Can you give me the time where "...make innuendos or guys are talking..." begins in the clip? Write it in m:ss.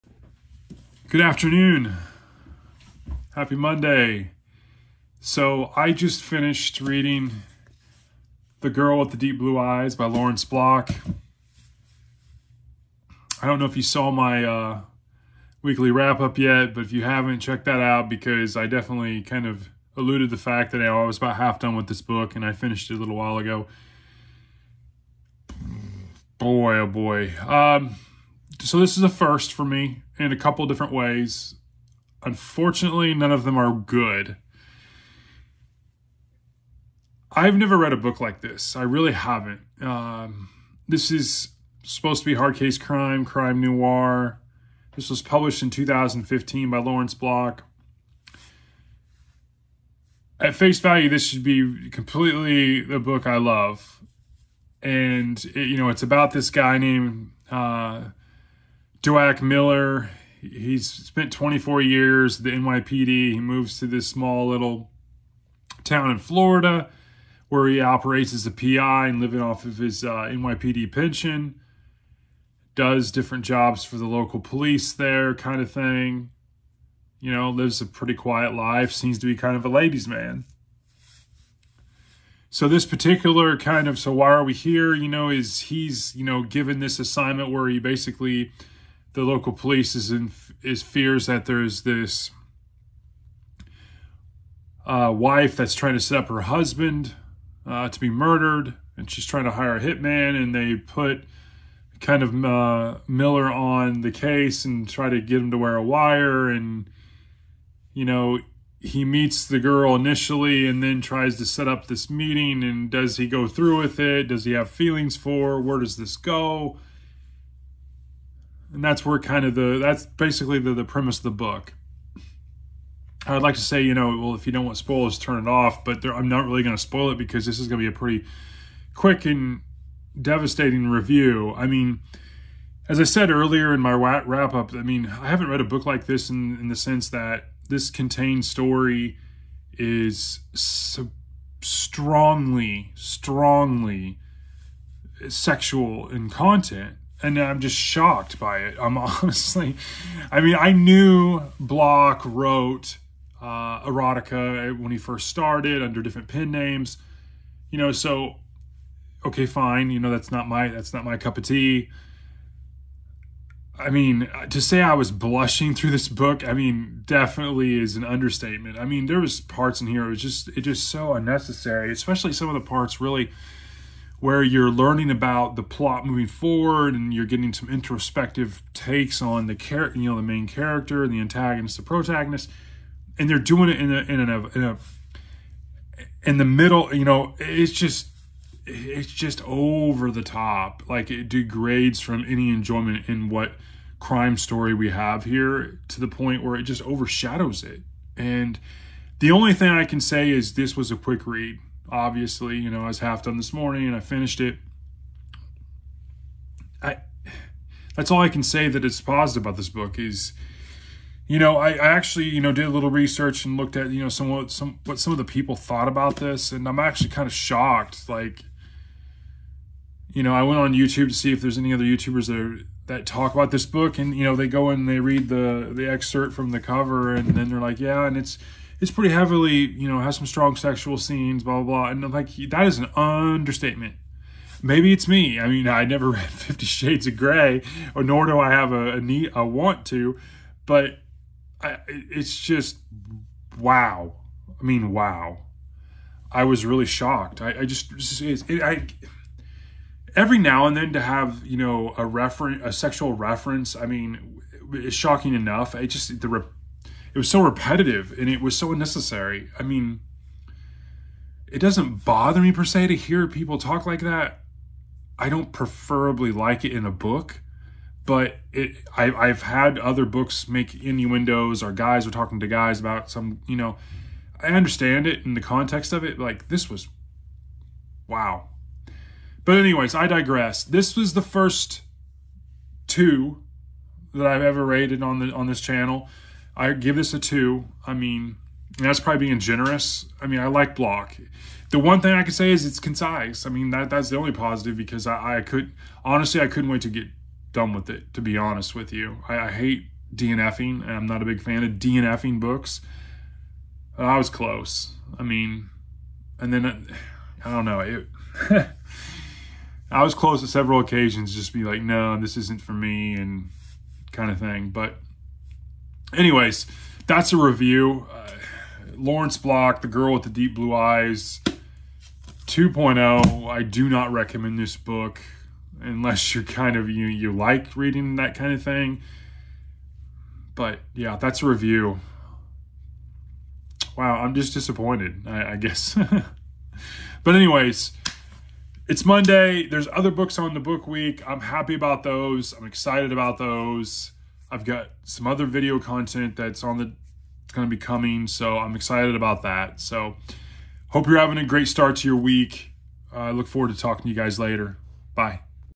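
4:30.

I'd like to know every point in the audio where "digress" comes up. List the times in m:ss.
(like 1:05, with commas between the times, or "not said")
4:40.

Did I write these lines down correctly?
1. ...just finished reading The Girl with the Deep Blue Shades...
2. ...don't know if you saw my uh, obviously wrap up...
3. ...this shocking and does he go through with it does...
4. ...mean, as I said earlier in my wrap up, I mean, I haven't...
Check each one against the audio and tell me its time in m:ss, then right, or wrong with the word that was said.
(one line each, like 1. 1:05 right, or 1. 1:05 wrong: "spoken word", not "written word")
1. 0:05 wrong: "Eyes", not "Shades"
2. 0:13 wrong: "weekly", not "obviously"
3. 1:51 wrong: "meeting", not "shocking"
4. 2:11 right.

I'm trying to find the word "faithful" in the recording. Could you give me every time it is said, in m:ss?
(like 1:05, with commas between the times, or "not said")
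not said.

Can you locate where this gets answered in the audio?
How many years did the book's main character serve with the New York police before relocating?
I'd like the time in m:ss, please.
1:01.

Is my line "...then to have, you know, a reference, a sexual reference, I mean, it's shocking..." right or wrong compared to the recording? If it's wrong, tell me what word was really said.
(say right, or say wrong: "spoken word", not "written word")
right.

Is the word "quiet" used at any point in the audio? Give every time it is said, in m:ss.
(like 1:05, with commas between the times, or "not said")
1:18.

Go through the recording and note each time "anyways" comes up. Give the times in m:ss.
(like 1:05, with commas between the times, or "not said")
4:39, 5:16, 5:37.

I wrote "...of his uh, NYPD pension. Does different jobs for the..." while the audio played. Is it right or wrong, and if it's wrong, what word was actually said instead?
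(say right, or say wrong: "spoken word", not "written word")
right.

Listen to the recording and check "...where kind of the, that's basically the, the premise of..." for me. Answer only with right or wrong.
right.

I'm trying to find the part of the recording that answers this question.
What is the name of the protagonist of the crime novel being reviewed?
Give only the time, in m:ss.
0:59.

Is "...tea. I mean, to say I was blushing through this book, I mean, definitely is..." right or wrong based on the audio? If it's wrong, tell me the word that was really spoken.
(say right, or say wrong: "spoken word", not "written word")
right.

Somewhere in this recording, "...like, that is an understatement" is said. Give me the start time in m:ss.
3:52.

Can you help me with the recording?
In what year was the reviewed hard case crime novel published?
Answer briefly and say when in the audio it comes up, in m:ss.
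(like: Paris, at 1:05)
2015, at 0:45.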